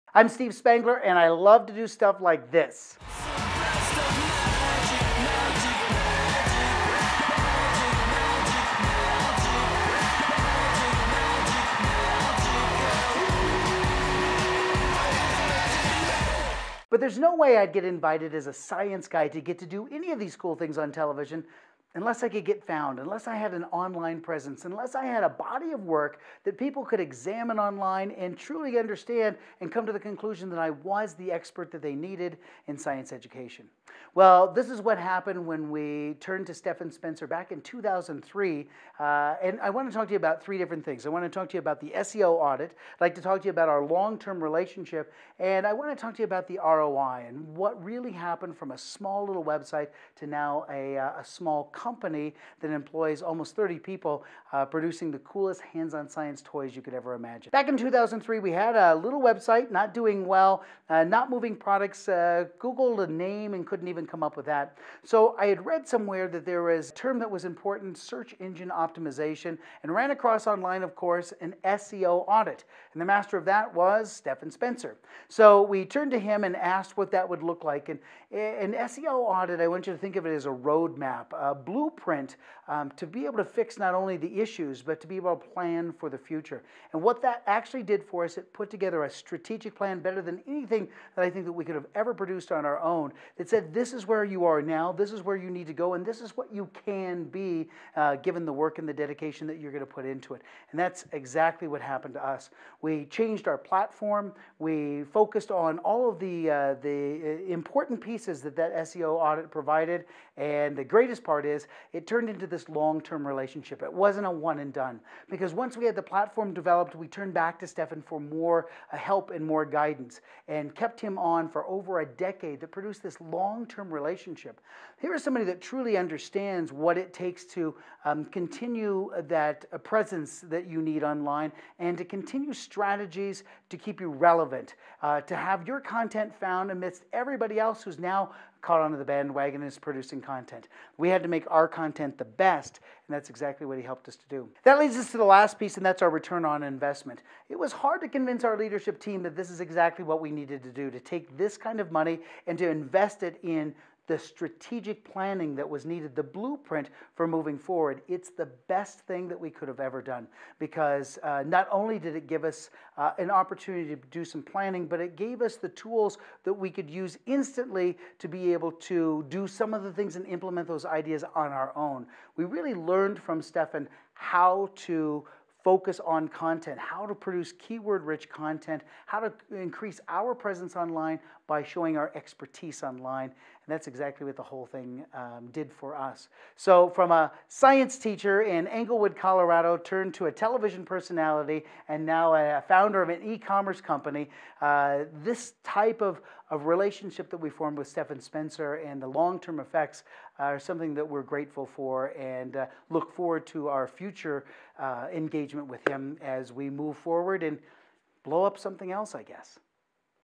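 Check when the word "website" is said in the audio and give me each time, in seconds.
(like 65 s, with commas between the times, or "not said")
49 s, 59 s.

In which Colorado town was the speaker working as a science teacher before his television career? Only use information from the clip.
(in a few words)
Englewood.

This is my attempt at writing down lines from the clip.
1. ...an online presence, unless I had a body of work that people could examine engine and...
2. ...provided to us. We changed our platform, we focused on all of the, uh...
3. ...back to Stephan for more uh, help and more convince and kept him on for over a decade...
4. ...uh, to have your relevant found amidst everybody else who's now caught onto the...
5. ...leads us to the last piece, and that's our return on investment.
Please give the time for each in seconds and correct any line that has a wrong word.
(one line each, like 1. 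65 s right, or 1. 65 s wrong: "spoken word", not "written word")
1. 23 s wrong: "online", not "engine"
2. 101 s wrong: "happened", not "provided"
3. 117 s wrong: "guidance", not "convince"
4. 135 s wrong: "content", not "relevant"
5. 144 s right.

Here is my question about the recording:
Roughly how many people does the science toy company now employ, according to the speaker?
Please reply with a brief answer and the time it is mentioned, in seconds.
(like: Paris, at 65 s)
30, at 53 s.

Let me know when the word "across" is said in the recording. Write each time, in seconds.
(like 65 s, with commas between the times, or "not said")
70 s.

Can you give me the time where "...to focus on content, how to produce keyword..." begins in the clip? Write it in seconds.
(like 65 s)
174 s.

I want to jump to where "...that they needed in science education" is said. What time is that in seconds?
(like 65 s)
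31 s.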